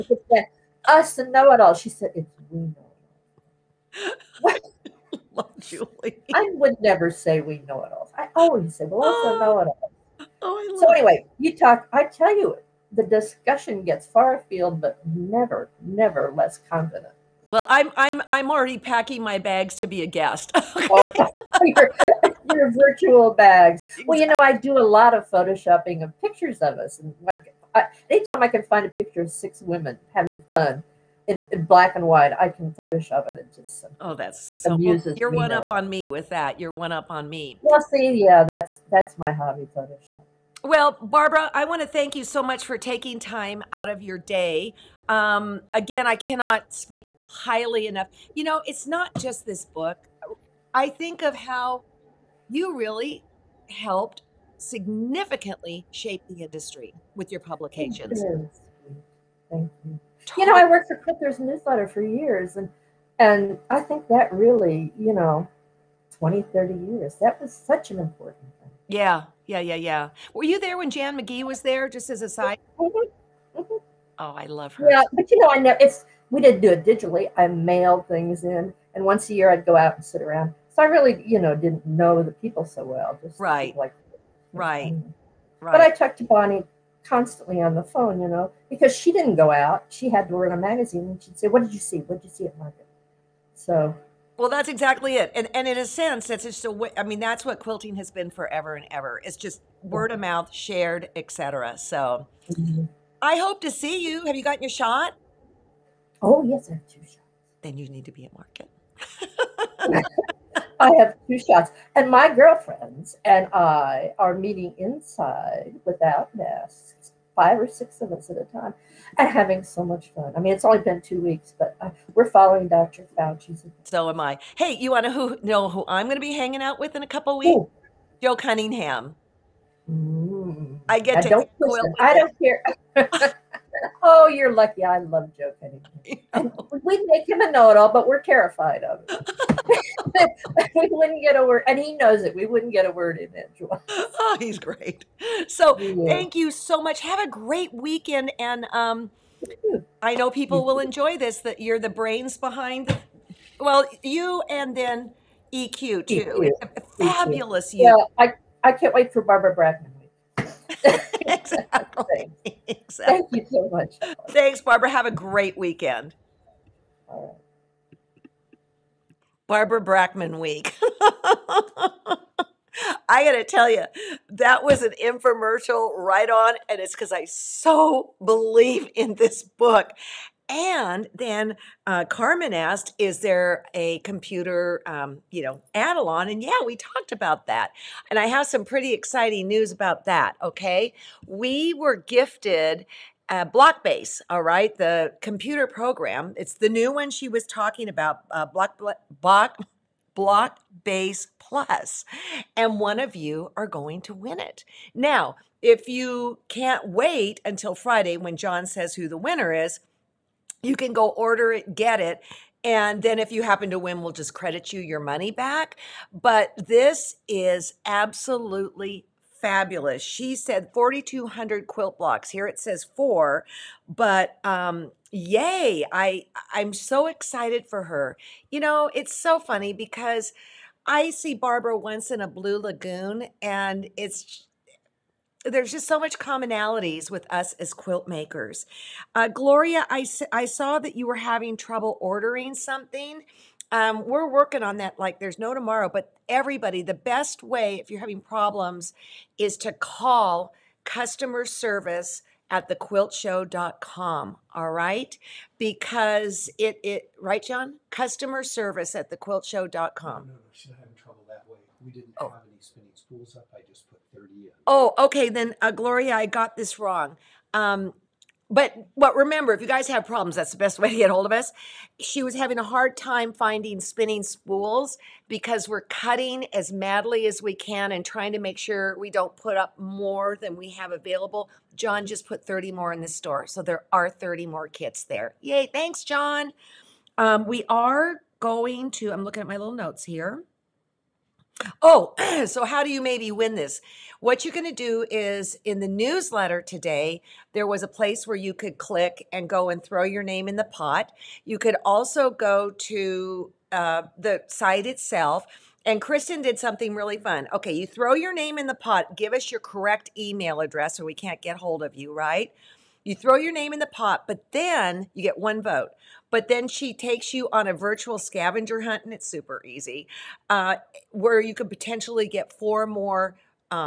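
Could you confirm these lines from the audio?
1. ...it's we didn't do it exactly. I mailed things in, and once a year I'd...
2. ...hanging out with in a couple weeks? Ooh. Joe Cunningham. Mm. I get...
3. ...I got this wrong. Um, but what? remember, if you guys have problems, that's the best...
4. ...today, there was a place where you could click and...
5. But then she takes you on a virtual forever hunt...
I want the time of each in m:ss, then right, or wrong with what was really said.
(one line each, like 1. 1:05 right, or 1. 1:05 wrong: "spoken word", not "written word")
1. 1:15 wrong: "digitally", not "exactly"
2. 2:06 right
3. 4:26 right
4. 4:56 right
5. 5:16 wrong: "scavenger", not "forever".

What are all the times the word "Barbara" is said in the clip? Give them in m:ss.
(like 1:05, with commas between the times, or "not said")
0:41, 2:39, 2:44, 2:49, 3:51.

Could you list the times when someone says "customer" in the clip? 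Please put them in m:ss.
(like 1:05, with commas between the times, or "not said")
4:10, 4:17.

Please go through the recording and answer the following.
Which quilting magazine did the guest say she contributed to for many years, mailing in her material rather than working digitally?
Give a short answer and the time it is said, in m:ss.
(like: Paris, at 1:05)
Quilter's Newsletter, at 1:00.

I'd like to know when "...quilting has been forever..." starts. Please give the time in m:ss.
1:37.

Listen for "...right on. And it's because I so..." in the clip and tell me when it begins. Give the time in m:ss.
2:55.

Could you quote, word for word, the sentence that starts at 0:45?
Um, again, I cannot speak highly enough.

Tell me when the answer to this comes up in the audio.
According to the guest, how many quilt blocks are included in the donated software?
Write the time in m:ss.
3:40.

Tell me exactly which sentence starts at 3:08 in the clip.
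And I have some pretty exciting news about that.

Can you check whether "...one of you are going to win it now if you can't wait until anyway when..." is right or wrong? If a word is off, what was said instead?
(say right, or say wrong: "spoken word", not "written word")
wrong: "friday", not "anyway".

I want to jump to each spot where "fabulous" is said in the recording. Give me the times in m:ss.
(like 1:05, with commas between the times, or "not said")
2:36, 3:39.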